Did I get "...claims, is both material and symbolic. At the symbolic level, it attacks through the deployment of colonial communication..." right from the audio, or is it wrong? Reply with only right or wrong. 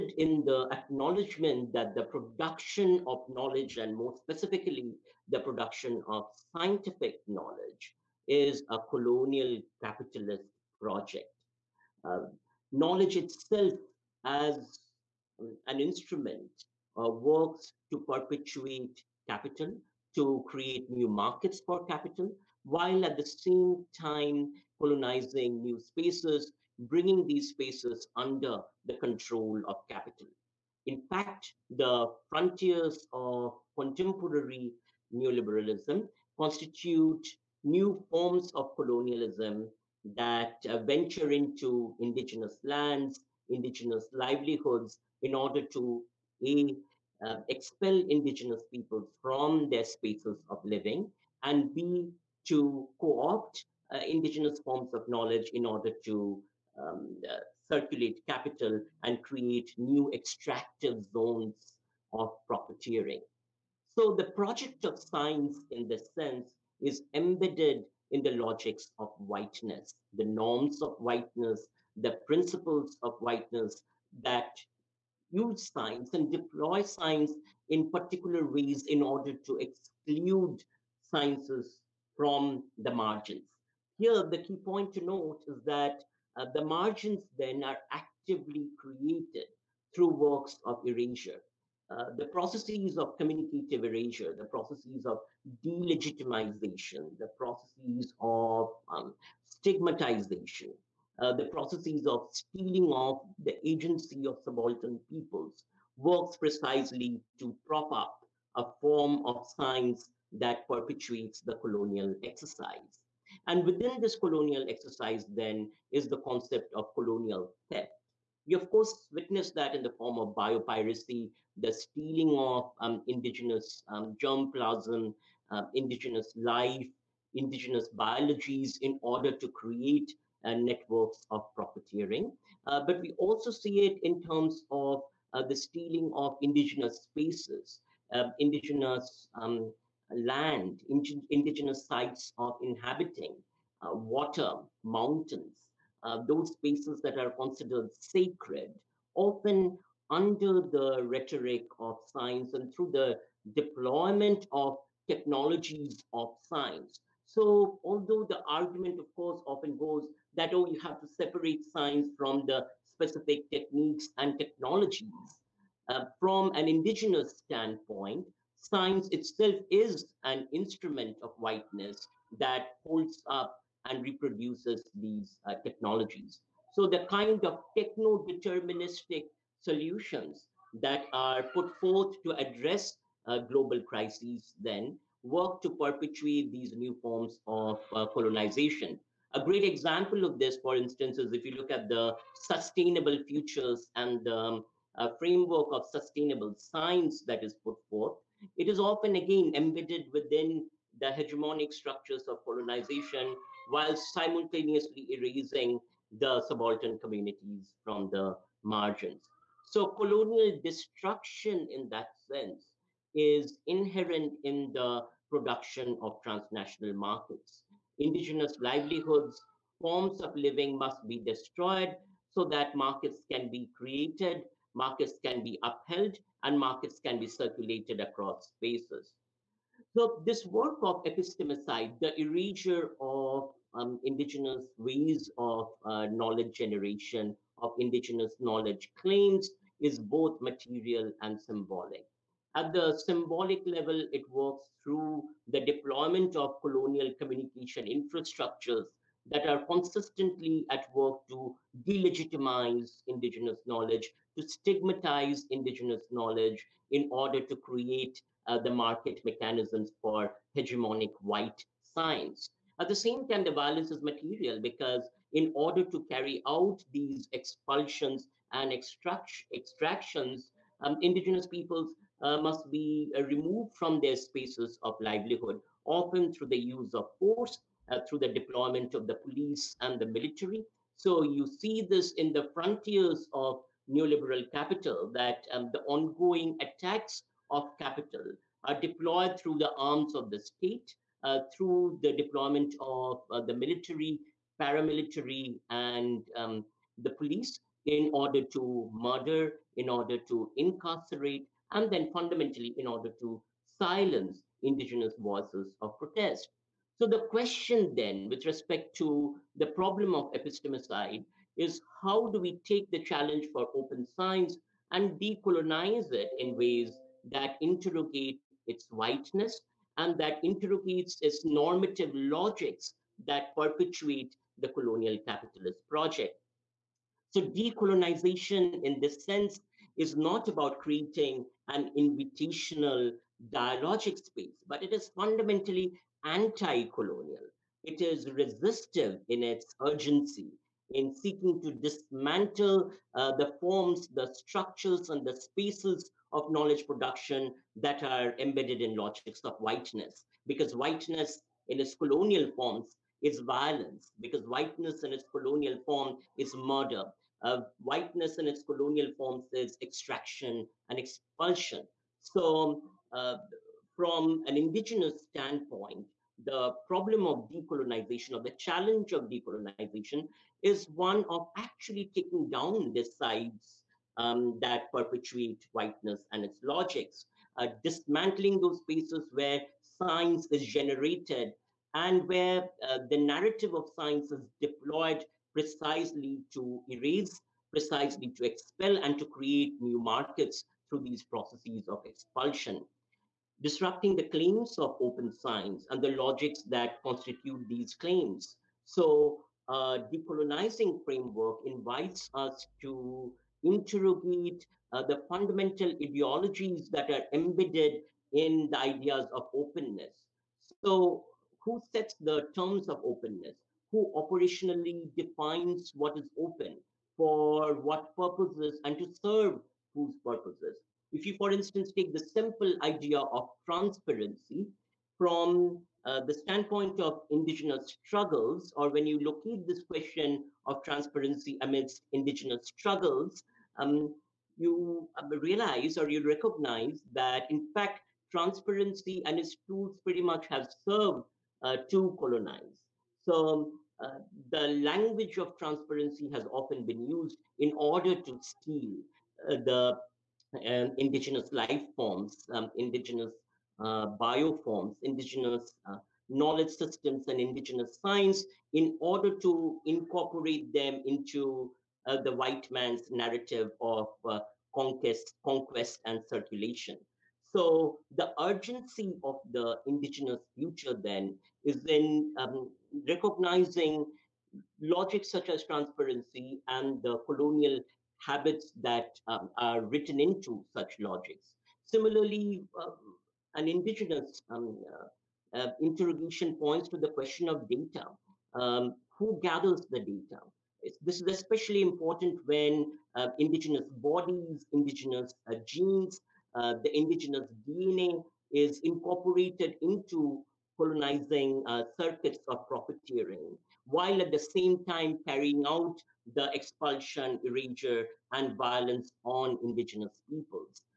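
wrong.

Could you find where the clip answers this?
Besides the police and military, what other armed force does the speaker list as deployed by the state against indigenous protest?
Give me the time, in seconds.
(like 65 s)
294 s.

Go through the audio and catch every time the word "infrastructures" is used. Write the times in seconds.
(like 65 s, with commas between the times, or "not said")
247 s.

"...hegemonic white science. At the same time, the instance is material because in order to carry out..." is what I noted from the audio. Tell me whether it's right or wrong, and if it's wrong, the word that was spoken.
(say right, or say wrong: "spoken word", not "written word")
wrong: "violence", not "instance".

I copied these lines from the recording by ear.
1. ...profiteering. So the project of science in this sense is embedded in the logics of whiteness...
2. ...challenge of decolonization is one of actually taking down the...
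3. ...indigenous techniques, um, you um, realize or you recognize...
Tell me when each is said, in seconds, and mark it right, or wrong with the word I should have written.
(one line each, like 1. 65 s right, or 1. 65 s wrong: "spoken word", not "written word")
1. 62 s right
2. 368 s right
3. 432 s wrong: "struggles", not "techniques".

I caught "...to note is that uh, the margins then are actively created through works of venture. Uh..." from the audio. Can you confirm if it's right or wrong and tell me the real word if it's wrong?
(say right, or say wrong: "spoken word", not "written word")
wrong: "erasure", not "venture".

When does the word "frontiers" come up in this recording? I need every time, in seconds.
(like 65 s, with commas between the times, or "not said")
32 s, 282 s.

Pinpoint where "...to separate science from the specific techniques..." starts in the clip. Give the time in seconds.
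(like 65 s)
161 s.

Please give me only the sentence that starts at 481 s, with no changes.
Similarly, um, and indigenous um, uh, uh, interrogation points to the question of data.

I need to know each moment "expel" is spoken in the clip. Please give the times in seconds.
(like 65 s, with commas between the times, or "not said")
47 s, 388 s.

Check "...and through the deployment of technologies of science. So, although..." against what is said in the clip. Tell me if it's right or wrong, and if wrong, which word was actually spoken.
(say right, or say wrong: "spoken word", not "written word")
right.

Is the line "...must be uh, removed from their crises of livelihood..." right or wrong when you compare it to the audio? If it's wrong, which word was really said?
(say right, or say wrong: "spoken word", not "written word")
wrong: "spaces", not "crises".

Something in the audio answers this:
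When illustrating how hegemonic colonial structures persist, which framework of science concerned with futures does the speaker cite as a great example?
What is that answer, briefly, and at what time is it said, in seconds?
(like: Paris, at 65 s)
sustainable science, at 195 s.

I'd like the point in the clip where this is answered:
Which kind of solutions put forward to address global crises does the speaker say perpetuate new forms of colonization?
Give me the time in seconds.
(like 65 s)
177 s.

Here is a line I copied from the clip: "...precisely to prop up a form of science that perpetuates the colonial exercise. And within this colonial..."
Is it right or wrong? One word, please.
right.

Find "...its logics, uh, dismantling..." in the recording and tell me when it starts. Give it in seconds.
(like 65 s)
376 s.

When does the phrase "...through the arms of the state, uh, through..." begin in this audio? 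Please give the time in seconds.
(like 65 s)
289 s.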